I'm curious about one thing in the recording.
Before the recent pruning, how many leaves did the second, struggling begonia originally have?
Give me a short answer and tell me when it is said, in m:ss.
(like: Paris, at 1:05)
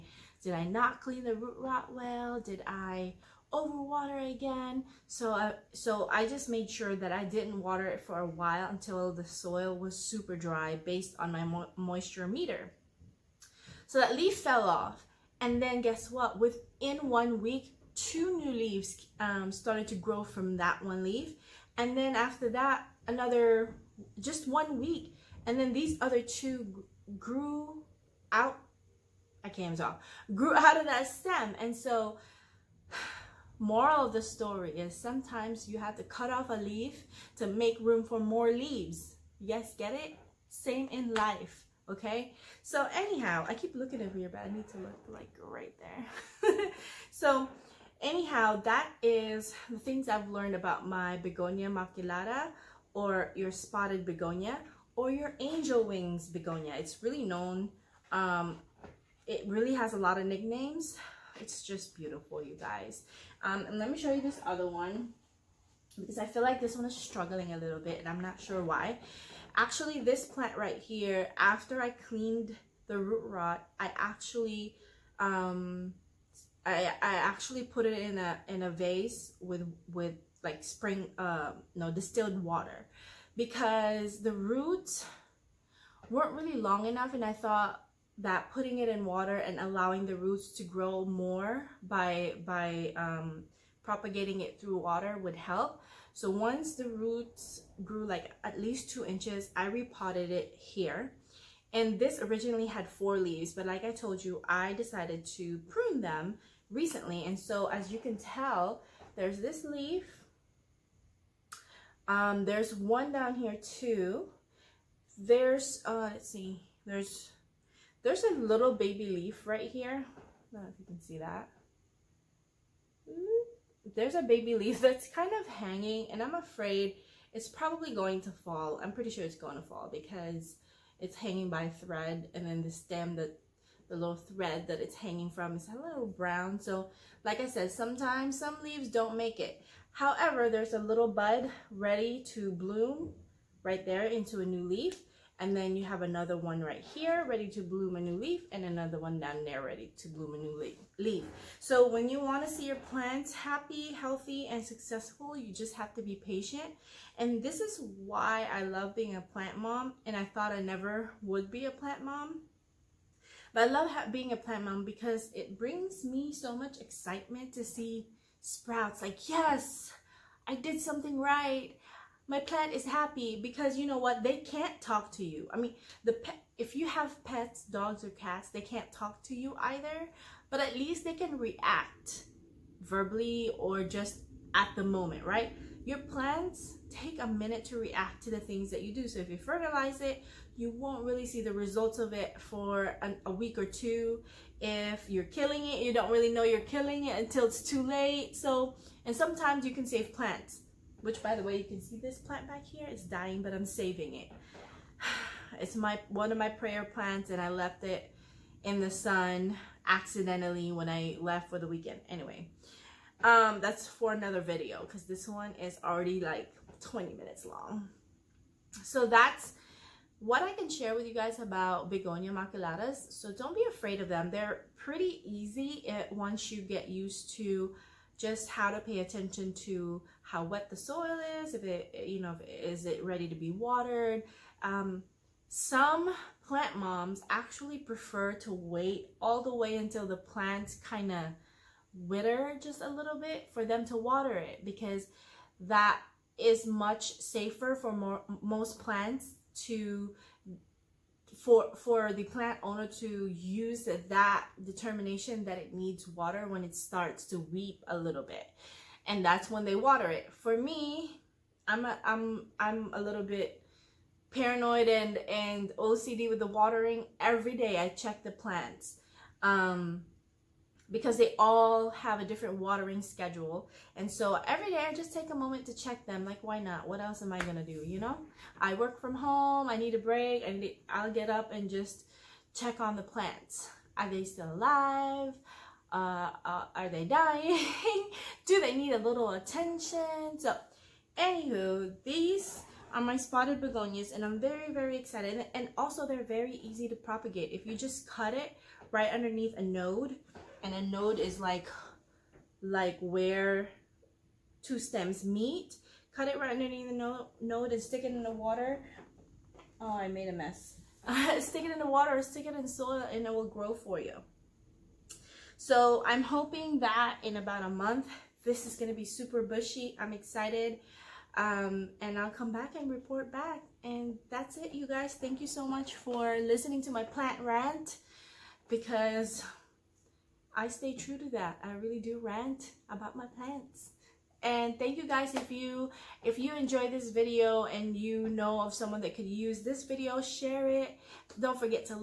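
4, at 1:42.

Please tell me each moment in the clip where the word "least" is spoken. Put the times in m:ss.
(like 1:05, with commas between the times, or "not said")
1:38, 3:00.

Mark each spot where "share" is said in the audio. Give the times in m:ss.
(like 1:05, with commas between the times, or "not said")
3:40, 5:40.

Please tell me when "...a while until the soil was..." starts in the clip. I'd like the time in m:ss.
0:08.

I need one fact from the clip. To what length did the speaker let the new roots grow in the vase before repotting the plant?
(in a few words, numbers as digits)
2 inches.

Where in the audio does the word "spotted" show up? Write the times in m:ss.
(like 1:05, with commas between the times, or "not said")
0:53, 4:53.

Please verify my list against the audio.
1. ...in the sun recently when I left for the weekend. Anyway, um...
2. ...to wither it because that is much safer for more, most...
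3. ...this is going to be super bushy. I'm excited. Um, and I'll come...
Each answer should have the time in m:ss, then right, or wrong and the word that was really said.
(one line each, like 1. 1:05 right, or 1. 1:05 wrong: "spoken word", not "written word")
1. 3:28 wrong: "accidentally", not "recently"
2. 4:03 wrong: "water", not "wither"
3. 5:18 right.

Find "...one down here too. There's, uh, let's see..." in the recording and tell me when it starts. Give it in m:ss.
1:52.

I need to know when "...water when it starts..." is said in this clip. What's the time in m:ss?
4:16.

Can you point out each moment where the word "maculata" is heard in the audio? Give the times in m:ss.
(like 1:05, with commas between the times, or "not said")
0:51, 3:42.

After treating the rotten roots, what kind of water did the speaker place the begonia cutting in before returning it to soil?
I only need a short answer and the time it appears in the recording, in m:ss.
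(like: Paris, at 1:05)
distilled water, at 1:21.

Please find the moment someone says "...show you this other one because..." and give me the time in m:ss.
1:03.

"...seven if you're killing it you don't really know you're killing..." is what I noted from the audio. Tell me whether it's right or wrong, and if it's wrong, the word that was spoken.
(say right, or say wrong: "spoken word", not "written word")
wrong: "two", not "seven".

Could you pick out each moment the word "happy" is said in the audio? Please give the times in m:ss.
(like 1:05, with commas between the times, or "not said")
2:33, 2:52.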